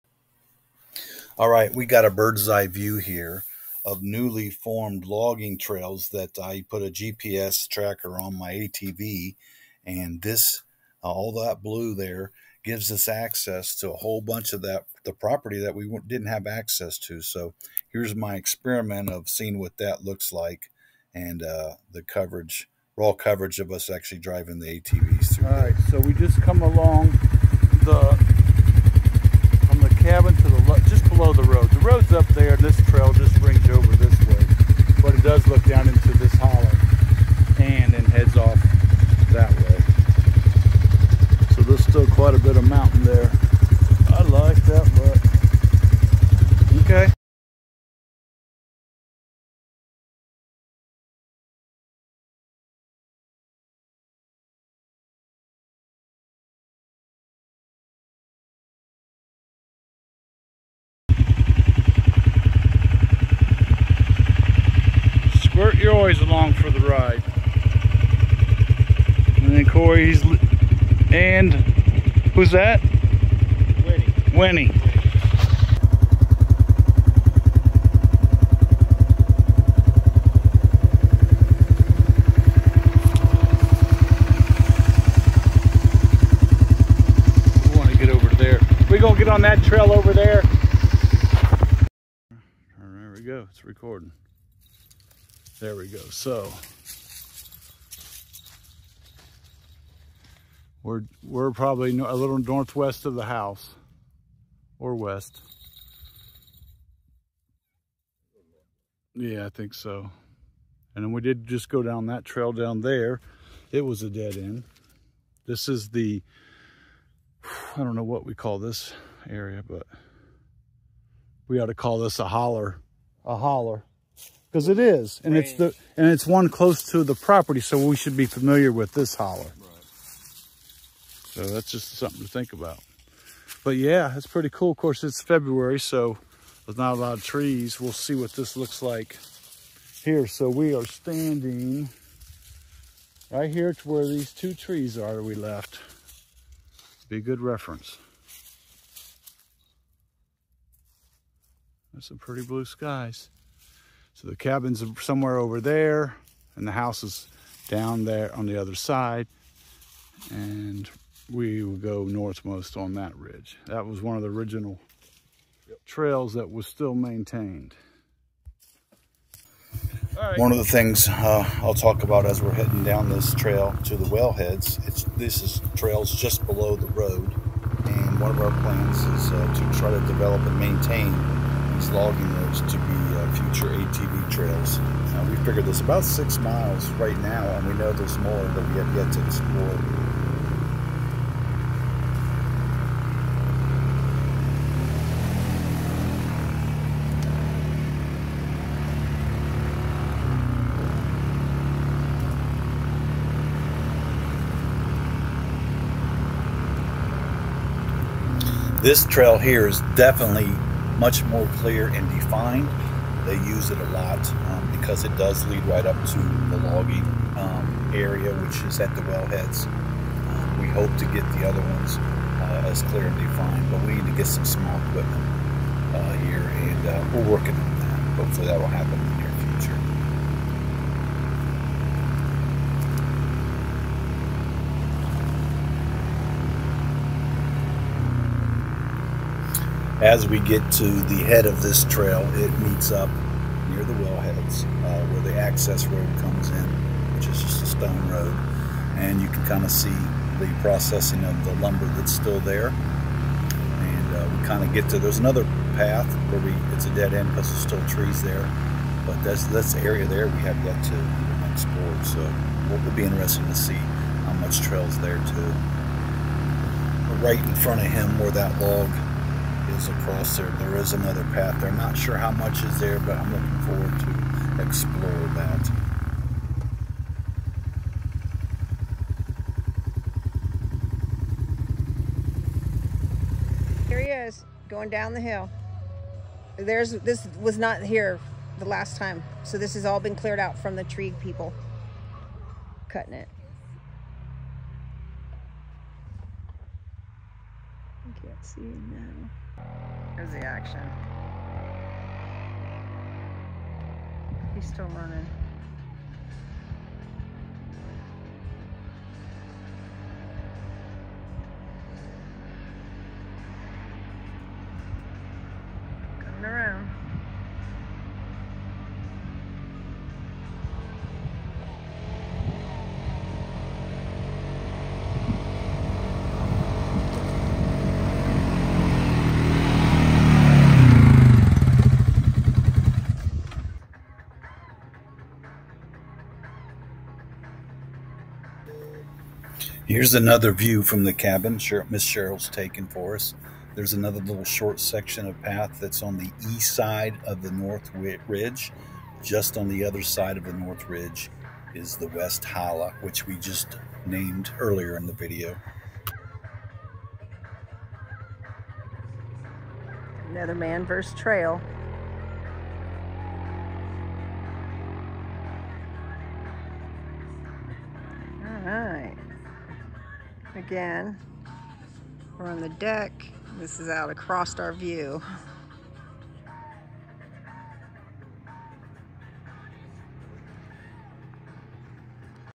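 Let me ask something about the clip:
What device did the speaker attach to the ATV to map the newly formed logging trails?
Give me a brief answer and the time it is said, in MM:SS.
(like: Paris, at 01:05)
GPS tracker, at 00:06.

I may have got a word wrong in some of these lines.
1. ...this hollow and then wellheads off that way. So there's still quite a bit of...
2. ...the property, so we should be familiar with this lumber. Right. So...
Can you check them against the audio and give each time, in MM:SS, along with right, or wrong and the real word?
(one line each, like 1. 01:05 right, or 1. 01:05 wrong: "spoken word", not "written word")
1. 00:36 wrong: "heads", not "wellheads"
2. 02:07 wrong: "holler", not "lumber".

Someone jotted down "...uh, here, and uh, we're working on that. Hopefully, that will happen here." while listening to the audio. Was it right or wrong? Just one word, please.
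right.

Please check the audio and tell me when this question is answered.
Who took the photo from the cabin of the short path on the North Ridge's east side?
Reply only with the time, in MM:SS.
05:41.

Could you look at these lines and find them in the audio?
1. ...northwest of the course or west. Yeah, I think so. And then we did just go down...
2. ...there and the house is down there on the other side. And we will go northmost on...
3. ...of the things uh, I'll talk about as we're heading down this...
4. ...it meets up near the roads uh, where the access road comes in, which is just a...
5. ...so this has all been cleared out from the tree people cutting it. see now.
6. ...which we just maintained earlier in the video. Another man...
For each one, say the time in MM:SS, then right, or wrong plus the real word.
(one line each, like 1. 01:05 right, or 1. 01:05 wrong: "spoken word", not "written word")
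1. 01:42 wrong: "house", not "course"
2. 02:35 right
3. 02:50 right
4. 04:02 wrong: "wellheads", not "roads"
5. 04:49 right
6. 05:53 wrong: "named", not "maintained".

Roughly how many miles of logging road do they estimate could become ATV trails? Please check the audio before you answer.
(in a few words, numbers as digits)
6.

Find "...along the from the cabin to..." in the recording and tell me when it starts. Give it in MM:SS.
00:26.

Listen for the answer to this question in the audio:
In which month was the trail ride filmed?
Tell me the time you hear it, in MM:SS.
02:15.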